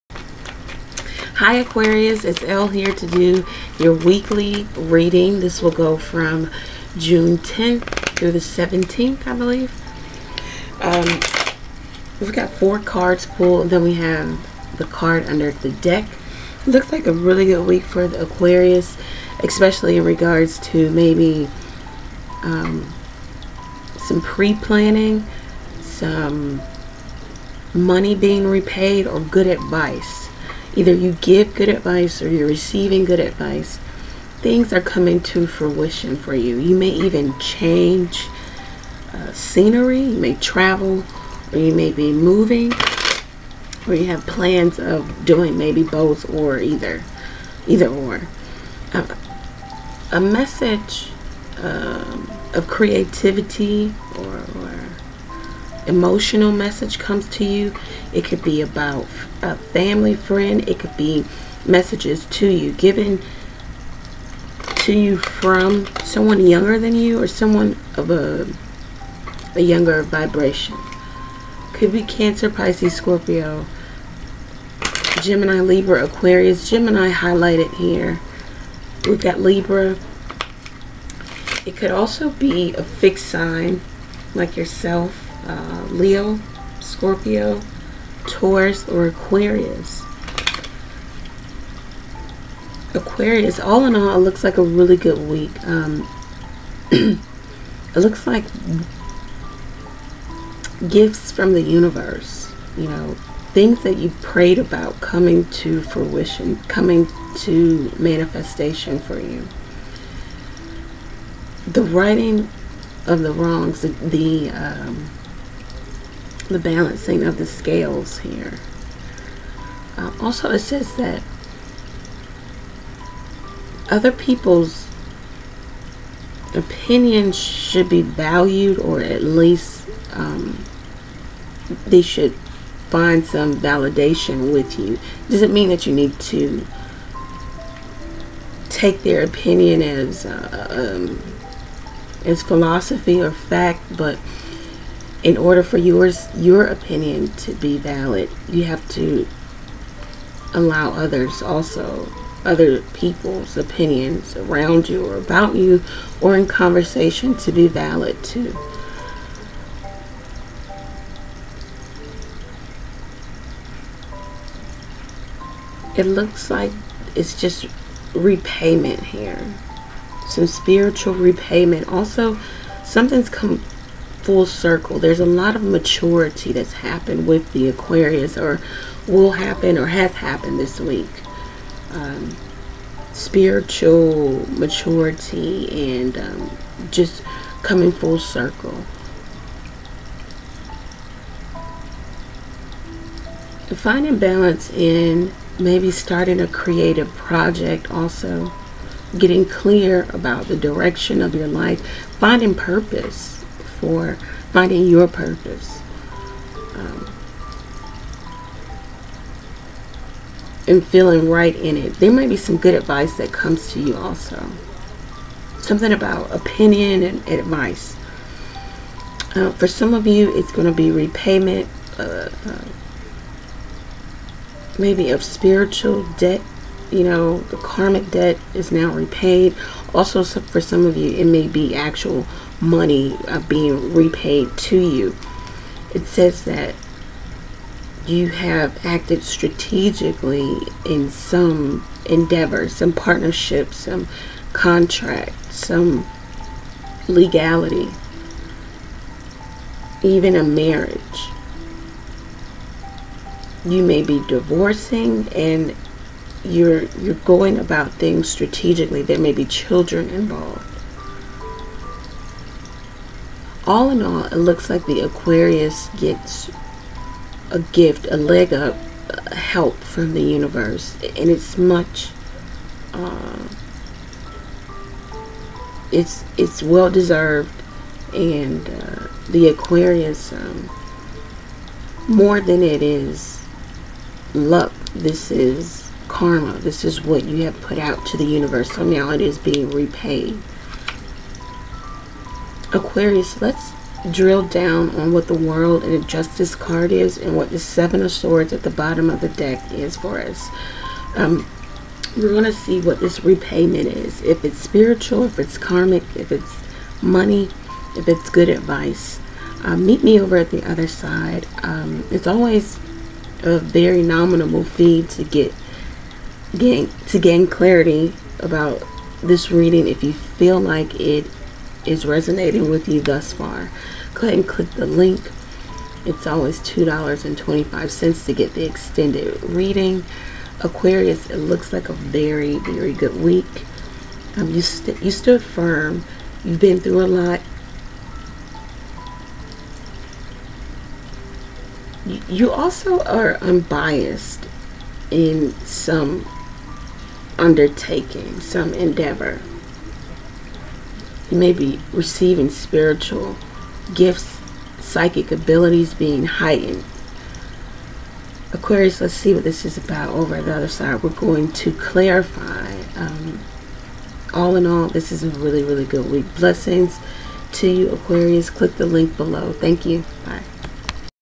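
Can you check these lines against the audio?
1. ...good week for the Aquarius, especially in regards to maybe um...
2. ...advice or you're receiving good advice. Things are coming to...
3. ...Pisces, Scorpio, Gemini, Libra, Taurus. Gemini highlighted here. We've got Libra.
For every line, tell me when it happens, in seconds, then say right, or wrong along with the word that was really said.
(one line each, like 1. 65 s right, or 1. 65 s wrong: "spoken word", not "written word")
1. 17 s right
2. 31 s right
3. 72 s wrong: "Aquarius", not "Taurus".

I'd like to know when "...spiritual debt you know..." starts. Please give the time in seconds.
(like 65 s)
225 s.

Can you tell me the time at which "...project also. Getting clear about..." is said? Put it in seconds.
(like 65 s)
197 s.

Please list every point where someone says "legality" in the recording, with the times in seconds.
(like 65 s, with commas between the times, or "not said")
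247 s.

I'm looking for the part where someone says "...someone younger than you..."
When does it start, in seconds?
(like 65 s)
66 s.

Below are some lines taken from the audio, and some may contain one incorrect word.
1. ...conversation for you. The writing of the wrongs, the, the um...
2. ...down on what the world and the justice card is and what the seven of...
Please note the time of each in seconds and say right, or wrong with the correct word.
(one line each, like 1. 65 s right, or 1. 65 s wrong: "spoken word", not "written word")
1. 107 s wrong: "manifestation", not "conversation"
2. 294 s right.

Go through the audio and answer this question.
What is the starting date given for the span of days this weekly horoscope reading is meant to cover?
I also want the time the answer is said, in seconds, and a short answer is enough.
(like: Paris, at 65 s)
June 10th, at 6 s.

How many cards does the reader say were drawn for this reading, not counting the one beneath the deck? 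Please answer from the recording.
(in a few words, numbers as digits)
4.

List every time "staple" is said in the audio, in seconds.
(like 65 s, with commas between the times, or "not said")
not said.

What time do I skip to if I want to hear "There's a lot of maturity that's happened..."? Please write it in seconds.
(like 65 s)
174 s.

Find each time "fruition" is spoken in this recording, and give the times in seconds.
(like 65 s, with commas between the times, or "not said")
35 s, 105 s.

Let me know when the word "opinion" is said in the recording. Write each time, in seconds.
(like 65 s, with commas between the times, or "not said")
126 s, 139 s, 146 s, 153 s, 216 s.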